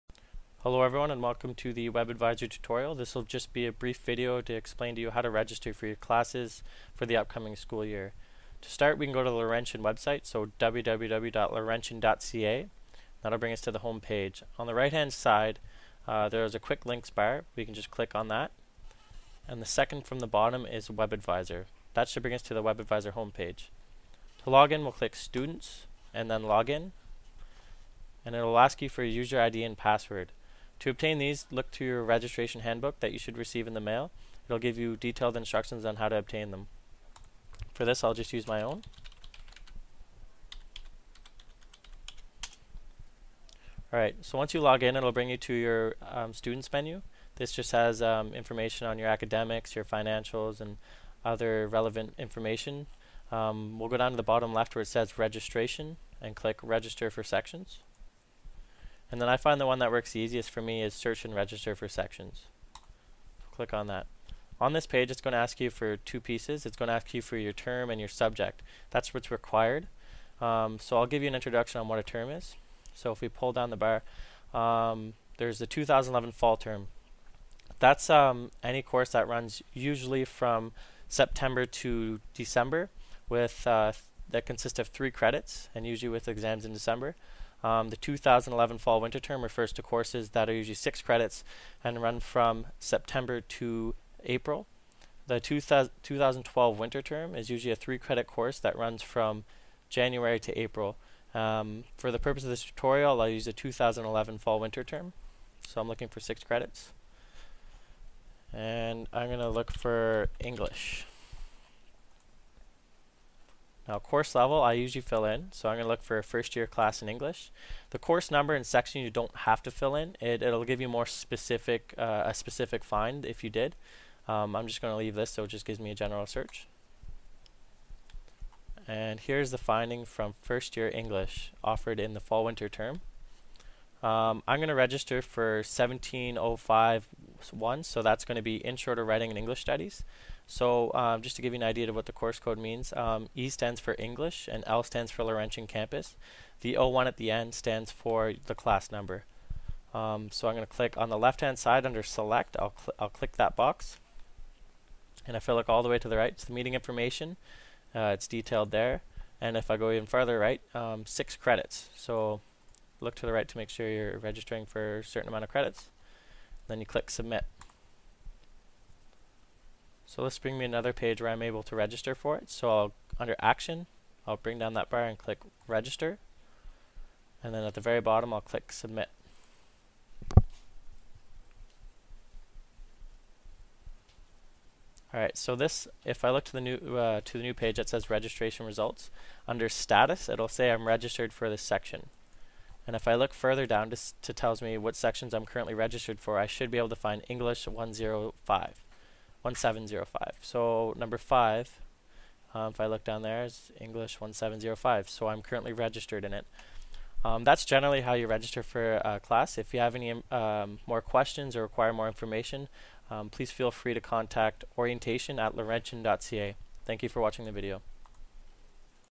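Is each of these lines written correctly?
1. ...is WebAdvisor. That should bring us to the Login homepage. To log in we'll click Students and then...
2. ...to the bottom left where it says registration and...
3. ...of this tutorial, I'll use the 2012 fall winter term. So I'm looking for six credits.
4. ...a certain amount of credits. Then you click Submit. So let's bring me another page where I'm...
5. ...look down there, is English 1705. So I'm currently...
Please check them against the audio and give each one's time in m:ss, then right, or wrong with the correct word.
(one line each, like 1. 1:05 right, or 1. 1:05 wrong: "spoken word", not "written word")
1. 0:20 wrong: "WebAdvisor", not "Login"
2. 0:54 right
3. 1:42 wrong: "2011", not "2012"
4. 2:44 right
5. 3:22 right.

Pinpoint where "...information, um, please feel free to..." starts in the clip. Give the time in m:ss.
3:32.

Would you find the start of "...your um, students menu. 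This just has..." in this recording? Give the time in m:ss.
0:45.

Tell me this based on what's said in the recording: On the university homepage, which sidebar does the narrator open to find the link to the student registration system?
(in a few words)
Quick links.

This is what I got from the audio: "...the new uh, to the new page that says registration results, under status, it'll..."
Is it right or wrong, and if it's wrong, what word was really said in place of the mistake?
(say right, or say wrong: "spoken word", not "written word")
right.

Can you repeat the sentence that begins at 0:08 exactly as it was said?
To start we can go to the Laurentian website, so www.laurentian.ca.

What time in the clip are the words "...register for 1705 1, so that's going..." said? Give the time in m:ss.
2:14.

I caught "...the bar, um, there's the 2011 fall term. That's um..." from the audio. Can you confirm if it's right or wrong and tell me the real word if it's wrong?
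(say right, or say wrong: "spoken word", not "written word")
right.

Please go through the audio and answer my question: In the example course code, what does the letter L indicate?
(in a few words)
Laurentian Campus.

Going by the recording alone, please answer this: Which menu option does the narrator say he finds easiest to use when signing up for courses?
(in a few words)
Search and register for sections.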